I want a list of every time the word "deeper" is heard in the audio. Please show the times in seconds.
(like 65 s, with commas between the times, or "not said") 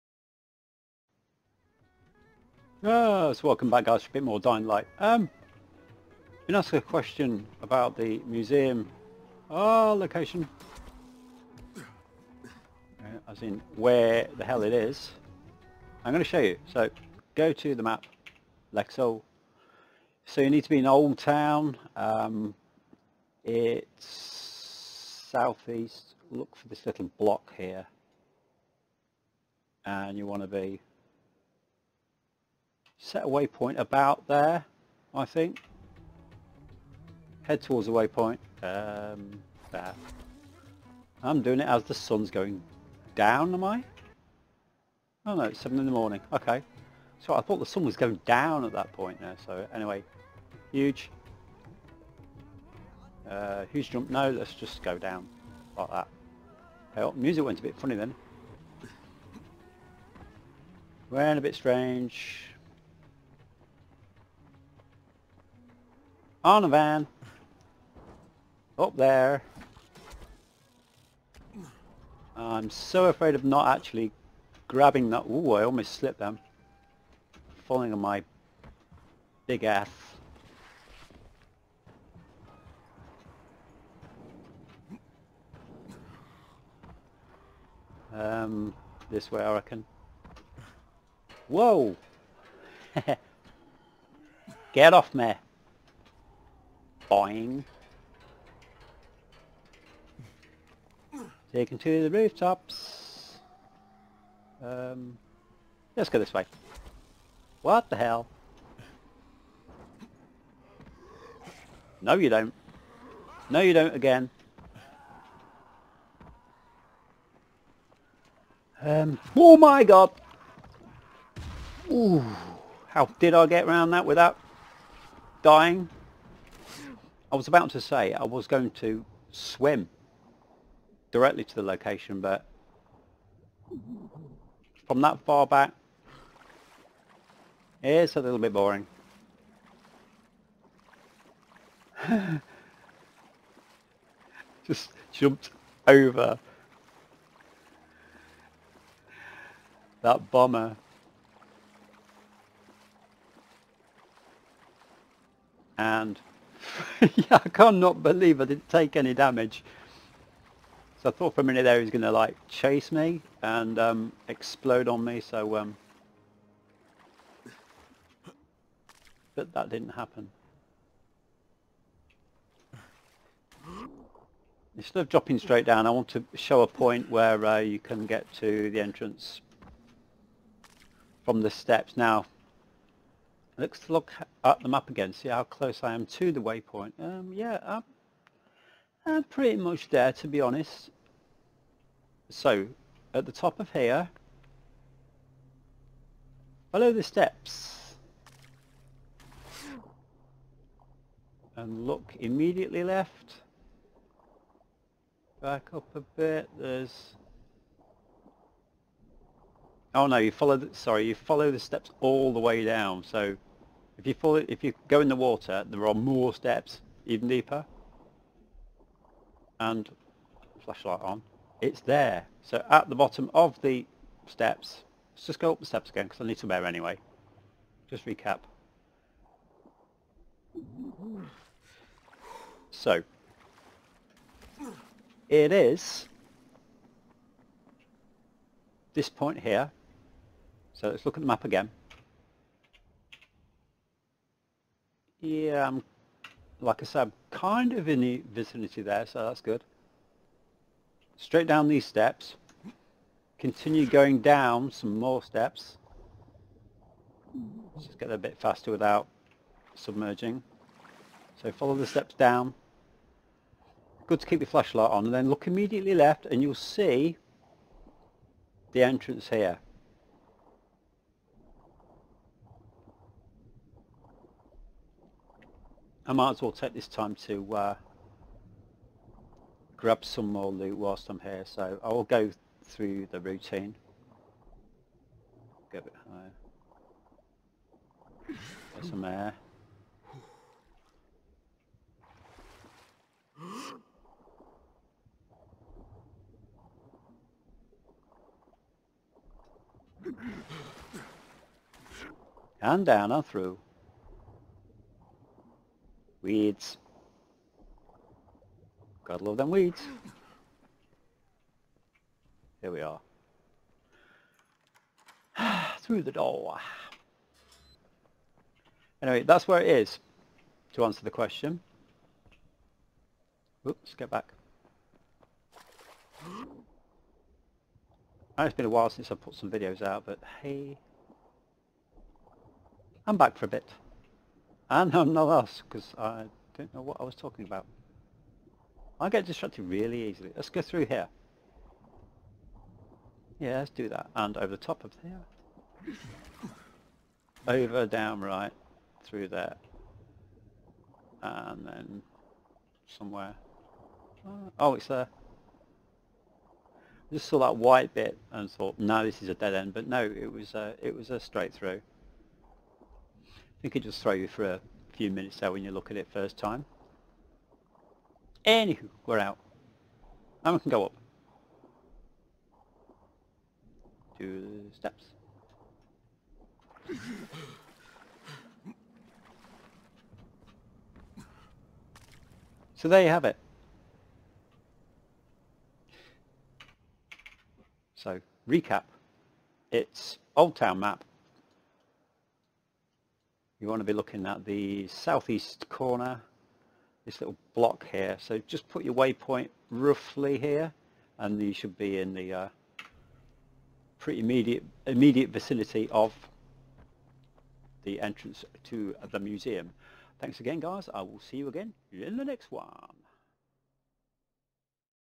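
217 s.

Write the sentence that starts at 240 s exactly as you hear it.
So let's look at the map again.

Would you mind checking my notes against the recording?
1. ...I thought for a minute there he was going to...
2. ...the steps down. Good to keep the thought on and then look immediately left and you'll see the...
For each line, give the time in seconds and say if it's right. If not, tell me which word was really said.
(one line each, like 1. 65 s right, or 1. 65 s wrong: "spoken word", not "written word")
1. 161 s right
2. 261 s wrong: "flashlight", not "thought".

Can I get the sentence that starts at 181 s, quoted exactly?
Now, Let's look at the map again, see how close I am to the waypoint.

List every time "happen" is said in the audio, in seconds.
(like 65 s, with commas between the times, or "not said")
169 s.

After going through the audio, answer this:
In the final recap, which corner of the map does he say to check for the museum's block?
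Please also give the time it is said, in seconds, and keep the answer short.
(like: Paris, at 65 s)
Southeast corner, at 394 s.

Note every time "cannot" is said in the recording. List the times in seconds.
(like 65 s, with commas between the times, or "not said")
157 s.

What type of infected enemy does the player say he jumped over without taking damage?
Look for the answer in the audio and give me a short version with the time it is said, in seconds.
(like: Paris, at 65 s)
Bomber, at 150 s.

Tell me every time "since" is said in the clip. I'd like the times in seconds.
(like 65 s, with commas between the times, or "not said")
328 s.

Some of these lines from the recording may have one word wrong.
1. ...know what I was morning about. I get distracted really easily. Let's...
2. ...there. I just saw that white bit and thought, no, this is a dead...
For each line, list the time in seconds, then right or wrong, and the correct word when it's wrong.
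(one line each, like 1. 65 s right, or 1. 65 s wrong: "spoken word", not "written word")
1. 336 s wrong: "talking", not "morning"
2. 354 s right.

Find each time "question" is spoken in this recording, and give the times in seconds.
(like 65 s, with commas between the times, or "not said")
6 s, 321 s.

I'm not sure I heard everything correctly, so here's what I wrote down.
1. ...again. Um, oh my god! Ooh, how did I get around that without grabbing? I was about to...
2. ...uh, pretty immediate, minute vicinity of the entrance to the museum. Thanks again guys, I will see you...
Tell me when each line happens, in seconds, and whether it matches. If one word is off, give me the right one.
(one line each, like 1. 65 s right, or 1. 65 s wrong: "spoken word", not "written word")
1. 113 s wrong: "dying", not "grabbing"
2. 402 s wrong: "immediate", not "minute".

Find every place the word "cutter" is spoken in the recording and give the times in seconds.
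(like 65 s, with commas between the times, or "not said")
not said.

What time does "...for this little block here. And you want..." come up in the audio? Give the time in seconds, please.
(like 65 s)
26 s.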